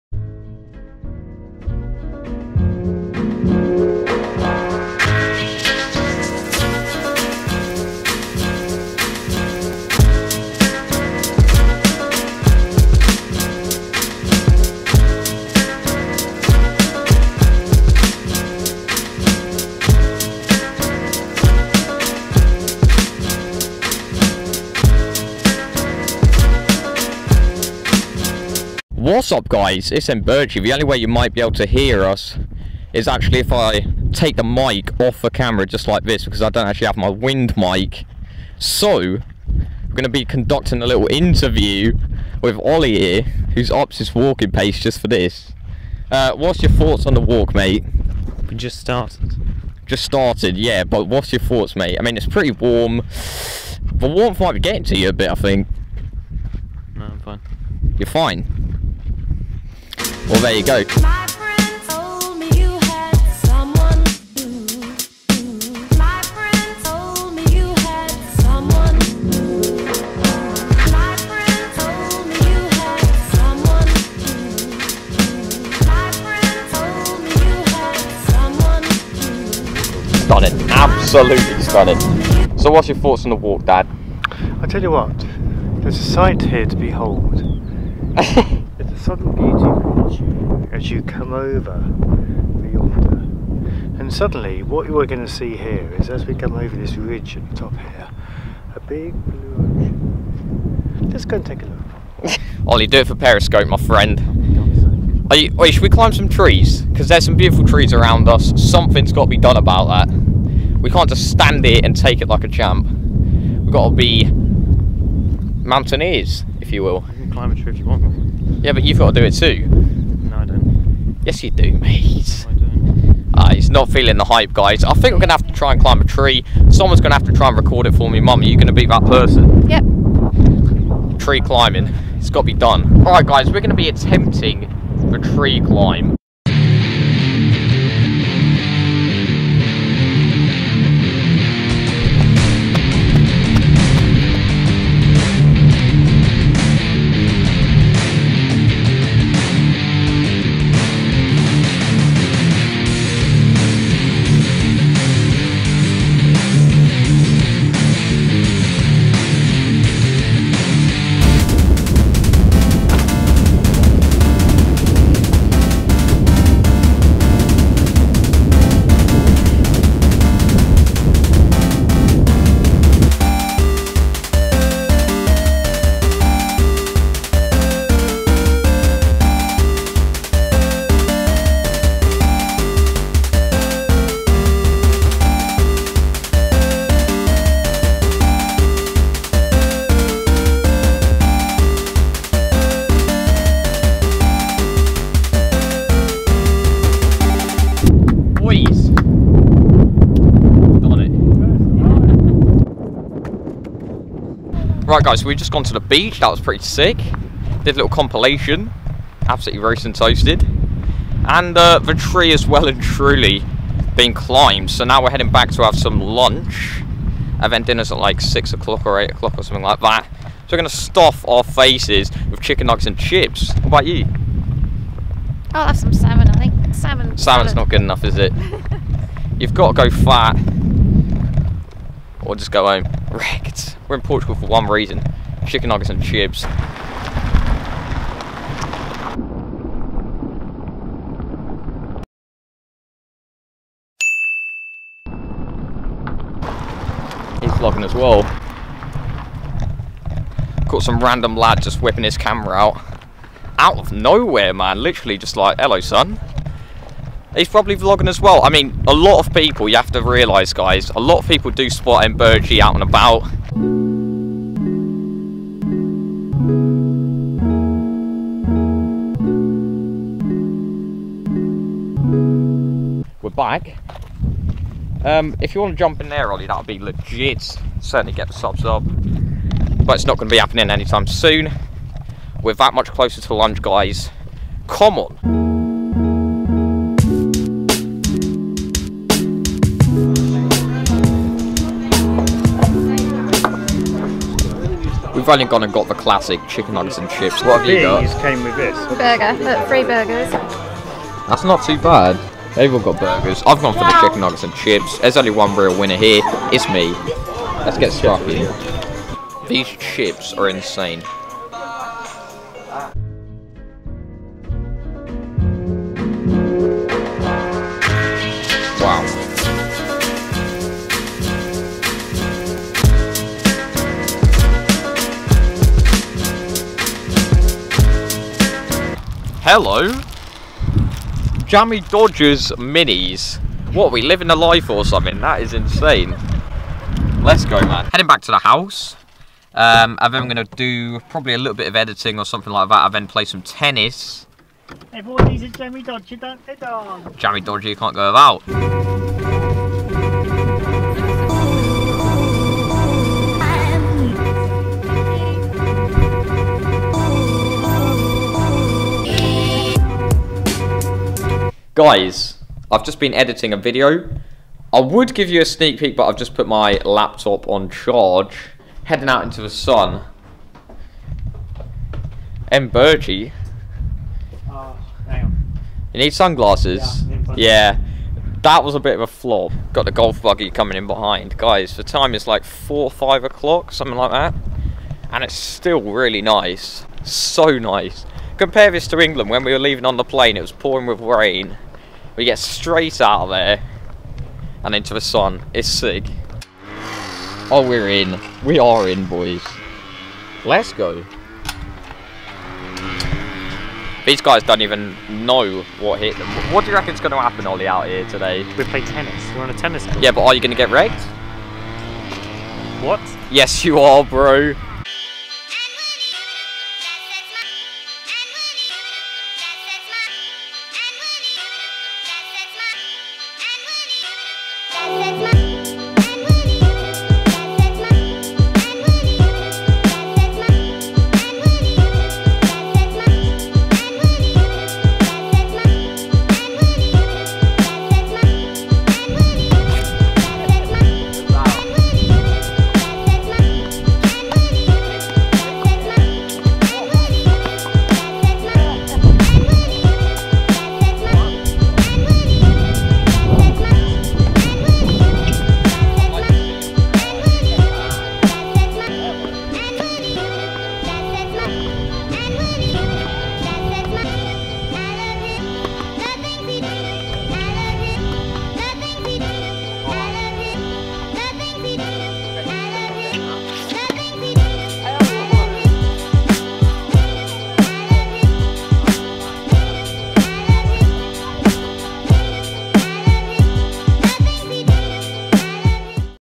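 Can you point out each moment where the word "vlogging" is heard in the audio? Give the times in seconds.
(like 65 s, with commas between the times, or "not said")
247 s, 257 s.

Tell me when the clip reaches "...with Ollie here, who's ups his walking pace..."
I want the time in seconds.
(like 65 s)
42 s.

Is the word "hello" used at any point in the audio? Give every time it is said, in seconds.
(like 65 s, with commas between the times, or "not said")
255 s, 329 s.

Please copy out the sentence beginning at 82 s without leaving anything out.
So what's your thoughts on the walk, Dad?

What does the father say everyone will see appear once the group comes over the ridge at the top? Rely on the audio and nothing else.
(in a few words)
A big blue ocean.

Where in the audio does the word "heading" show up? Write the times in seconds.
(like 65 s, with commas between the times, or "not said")
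215 s, 337 s, 368 s.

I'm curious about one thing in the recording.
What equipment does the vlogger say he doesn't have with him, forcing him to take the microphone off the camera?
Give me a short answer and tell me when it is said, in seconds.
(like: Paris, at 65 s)
Wind mic, at 37 s.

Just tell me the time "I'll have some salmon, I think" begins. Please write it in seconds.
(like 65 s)
225 s.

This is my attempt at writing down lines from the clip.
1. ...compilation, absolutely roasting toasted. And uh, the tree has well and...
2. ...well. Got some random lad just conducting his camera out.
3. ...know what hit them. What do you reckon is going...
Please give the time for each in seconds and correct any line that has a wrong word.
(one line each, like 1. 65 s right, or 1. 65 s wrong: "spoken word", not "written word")
1. 207 s right
2. 247 s wrong: "whipping", not "conducting"
3. 405 s right.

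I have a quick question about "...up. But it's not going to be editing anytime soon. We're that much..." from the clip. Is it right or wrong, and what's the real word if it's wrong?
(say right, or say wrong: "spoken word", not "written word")
wrong: "happening", not "editing".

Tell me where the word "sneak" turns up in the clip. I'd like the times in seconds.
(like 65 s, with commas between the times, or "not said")
365 s.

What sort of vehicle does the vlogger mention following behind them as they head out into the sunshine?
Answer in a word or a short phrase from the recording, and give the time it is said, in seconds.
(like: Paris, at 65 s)
Golf buggy, at 379 s.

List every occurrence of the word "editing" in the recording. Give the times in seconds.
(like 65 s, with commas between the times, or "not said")
341 s, 363 s.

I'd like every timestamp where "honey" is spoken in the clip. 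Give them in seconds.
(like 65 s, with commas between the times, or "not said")
not said.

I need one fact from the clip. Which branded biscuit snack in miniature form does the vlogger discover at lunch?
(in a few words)
Jammy Dodgers Minis.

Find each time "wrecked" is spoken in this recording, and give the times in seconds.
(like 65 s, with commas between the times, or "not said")
233 s, 410 s.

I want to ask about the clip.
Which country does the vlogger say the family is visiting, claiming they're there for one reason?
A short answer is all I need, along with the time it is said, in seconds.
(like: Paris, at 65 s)
Portugal, at 234 s.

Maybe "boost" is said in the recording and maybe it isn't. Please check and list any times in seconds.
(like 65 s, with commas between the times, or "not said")
not said.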